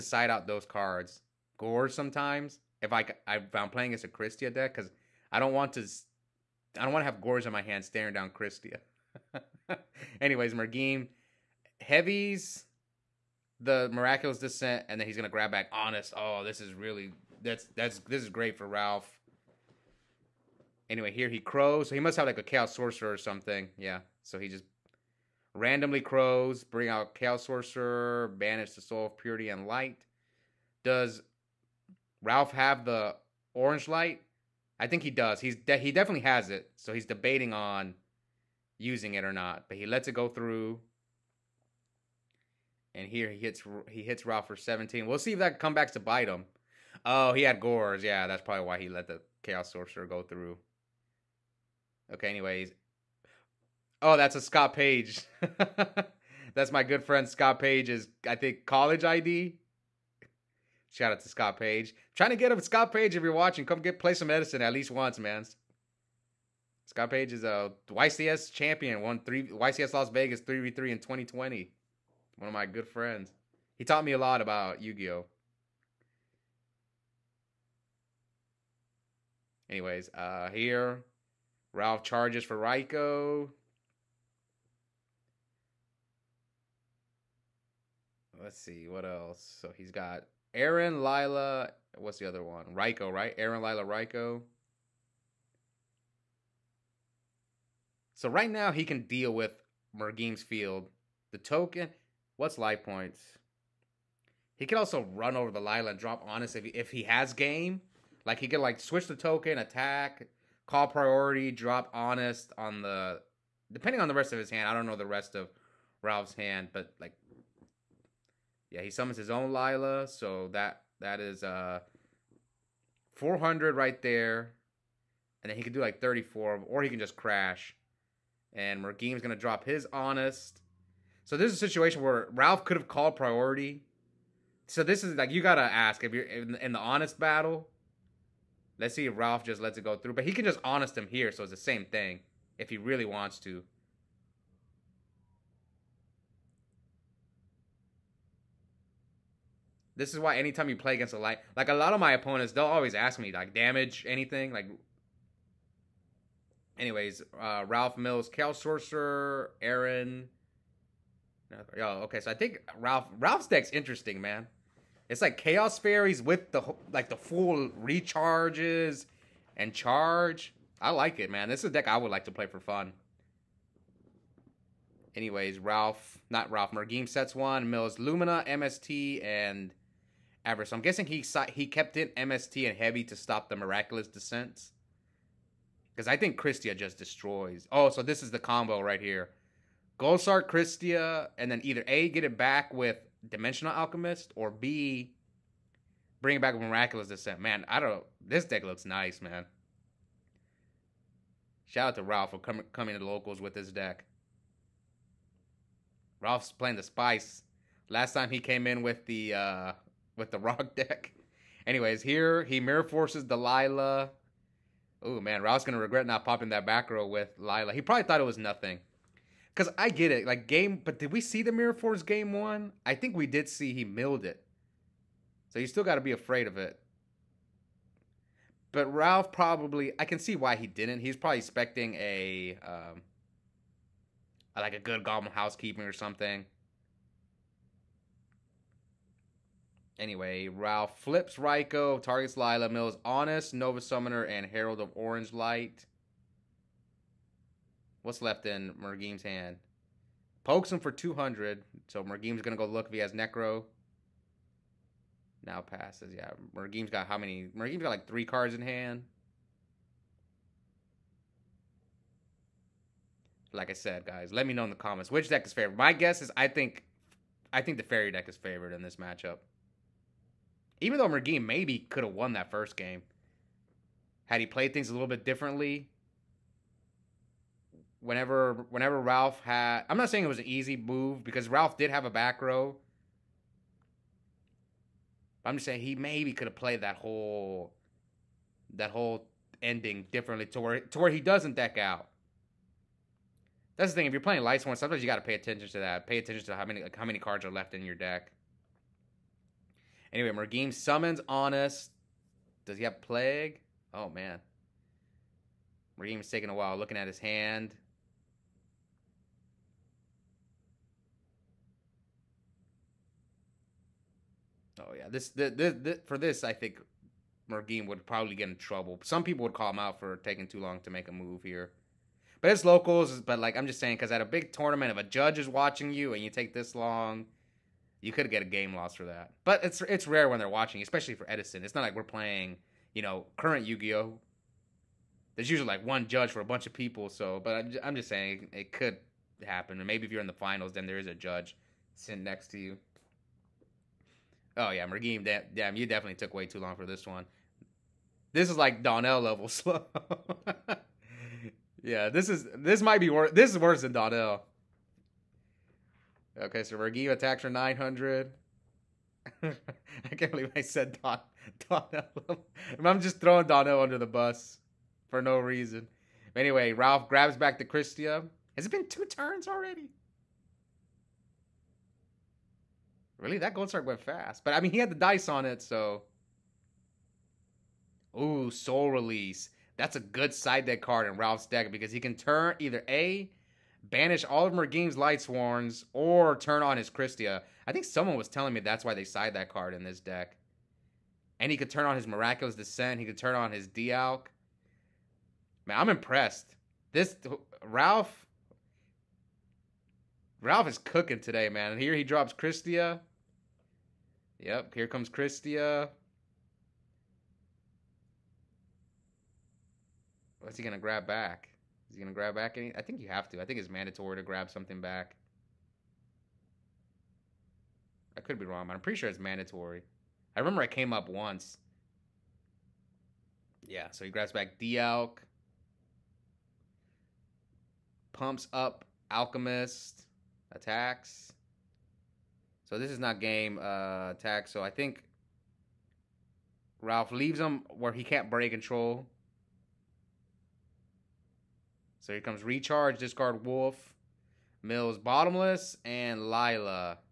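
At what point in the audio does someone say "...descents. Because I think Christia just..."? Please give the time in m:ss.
3:04.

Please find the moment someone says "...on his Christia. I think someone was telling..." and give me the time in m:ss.
6:26.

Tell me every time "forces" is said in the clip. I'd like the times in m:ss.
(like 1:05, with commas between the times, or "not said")
3:32, 3:41.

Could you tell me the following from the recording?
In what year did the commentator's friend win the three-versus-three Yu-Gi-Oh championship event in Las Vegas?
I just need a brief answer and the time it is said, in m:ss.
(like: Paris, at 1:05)
2020, at 1:10.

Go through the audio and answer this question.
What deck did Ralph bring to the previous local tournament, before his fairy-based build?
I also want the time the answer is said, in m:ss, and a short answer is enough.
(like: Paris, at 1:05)
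rock deck, at 3:30.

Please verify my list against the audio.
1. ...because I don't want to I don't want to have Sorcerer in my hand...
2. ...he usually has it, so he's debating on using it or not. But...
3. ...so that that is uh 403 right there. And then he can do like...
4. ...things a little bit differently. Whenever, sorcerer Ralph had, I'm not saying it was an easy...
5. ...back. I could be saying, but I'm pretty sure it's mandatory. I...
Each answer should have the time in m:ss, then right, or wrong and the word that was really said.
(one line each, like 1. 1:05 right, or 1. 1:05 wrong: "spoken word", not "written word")
1. 0:04 wrong: "Gorz", not "Sorcerer"
2. 0:35 wrong: "definitely", not "usually"
3. 2:00 wrong: "400", not "403"
4. 4:34 wrong: "whenever", not "sorcerer"
5. 6:54 wrong: "wrong", not "saying".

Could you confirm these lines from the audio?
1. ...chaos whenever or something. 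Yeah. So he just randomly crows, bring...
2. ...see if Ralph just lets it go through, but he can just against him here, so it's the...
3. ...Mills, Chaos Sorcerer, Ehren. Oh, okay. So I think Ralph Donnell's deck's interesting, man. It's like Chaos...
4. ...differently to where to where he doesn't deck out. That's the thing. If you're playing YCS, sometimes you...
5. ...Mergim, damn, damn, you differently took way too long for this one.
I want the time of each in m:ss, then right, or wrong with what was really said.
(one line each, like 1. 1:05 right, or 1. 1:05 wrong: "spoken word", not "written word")
1. 0:22 wrong: "sorcerer", not "whenever"
2. 2:18 wrong: "honest", not "against"
3. 2:37 wrong: "Ralph", not "Donnell"
4. 4:50 wrong: "Lightsworn", not "YCS"
5. 5:44 wrong: "definitely", not "differently".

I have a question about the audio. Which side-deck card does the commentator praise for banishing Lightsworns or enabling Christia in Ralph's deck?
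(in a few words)
Soul Release.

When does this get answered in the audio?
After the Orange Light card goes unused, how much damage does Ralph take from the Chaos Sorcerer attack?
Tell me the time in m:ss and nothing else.
0:44.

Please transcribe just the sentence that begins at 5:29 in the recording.
But it's it's rare when they're watching, especially for Edison.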